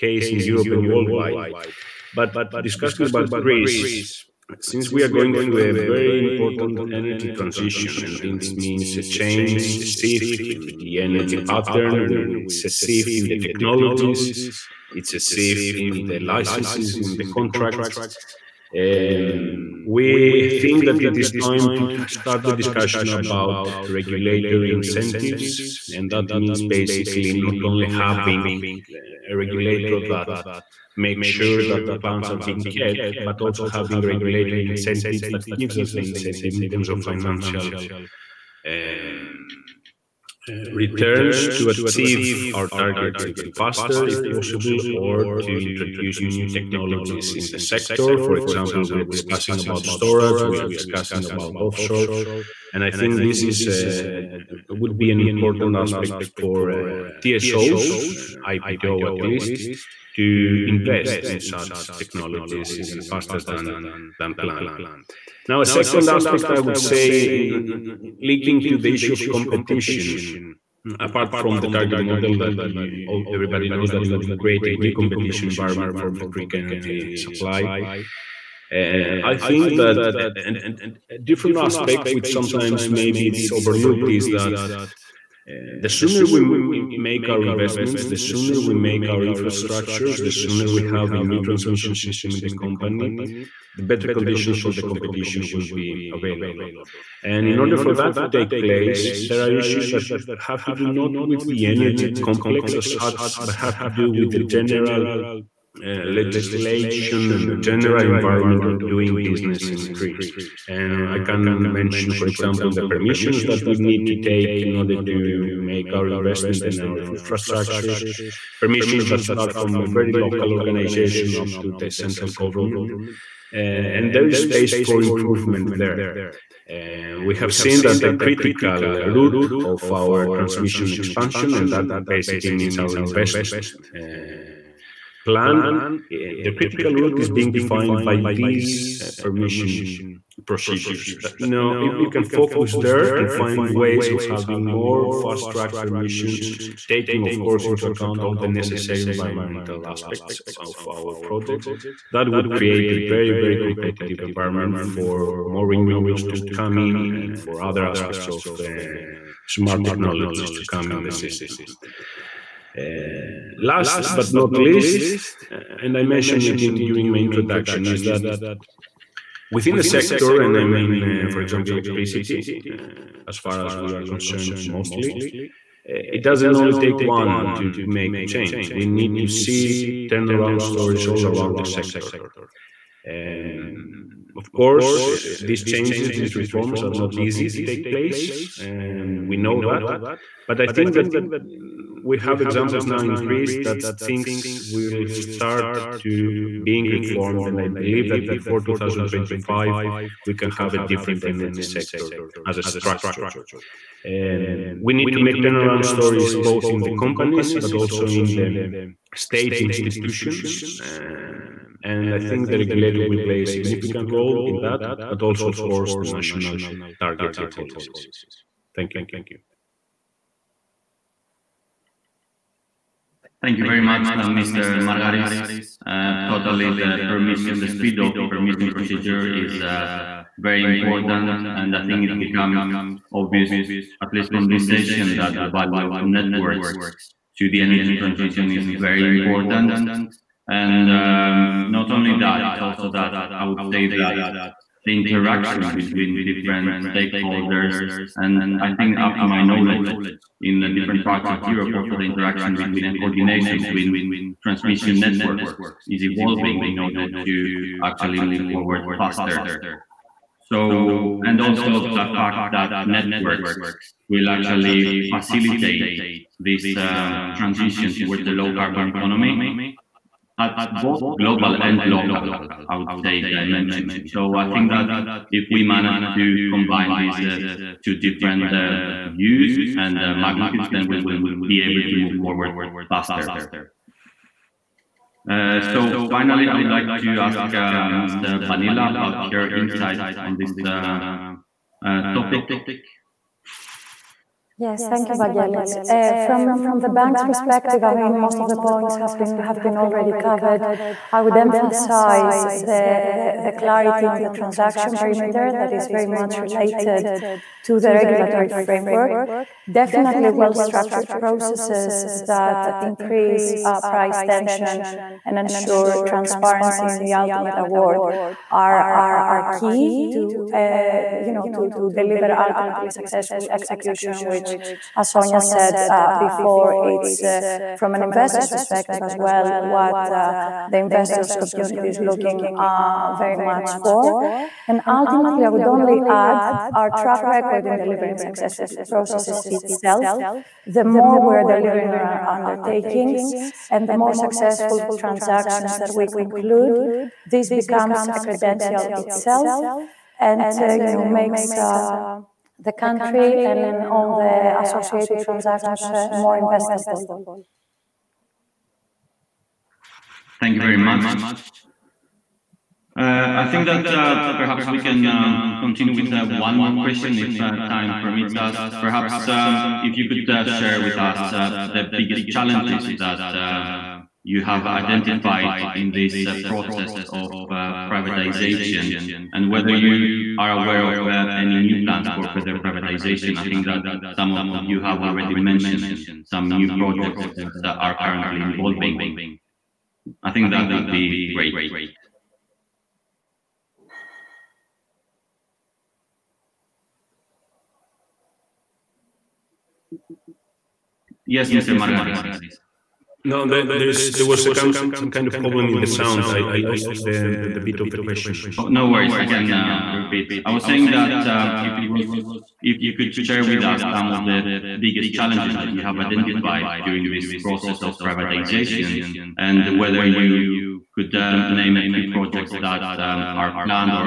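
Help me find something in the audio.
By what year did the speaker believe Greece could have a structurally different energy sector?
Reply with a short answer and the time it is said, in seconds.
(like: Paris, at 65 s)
2025, at 198 s.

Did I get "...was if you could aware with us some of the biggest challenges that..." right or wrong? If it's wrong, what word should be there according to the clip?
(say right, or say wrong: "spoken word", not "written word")
wrong: "share", not "aware".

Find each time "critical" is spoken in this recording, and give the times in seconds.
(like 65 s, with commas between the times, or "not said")
128 s, 136 s.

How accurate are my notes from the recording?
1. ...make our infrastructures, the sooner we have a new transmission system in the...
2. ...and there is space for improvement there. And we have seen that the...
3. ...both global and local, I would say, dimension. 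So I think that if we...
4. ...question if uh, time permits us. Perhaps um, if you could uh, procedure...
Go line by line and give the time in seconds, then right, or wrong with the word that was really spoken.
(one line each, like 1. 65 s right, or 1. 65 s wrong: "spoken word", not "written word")
1. 88 s right
2. 123 s right
3. 270 s right
4. 366 s wrong: "share", not "procedure".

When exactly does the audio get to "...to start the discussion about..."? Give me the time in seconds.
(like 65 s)
21 s.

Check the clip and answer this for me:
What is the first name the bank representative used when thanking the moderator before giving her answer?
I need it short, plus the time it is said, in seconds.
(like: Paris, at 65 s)
Vangelis, at 295 s.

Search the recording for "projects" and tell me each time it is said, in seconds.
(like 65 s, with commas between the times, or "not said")
151 s, 386 s, 422 s.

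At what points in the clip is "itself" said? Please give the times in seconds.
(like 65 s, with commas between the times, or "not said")
339 s, 348 s.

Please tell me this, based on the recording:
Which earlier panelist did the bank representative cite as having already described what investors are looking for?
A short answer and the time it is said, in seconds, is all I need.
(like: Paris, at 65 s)
Sonia, at 325 s.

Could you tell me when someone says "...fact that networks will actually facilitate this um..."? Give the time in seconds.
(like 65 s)
262 s.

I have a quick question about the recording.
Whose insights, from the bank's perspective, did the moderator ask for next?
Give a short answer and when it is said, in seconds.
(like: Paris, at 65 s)
Ms. Banila, at 288 s.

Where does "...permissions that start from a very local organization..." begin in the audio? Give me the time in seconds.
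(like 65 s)
118 s.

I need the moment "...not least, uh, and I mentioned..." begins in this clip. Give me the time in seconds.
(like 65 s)
164 s.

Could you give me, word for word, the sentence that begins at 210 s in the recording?
Um, and I think the regulator will play a significant role in that, but also, of course, the national targets and policies.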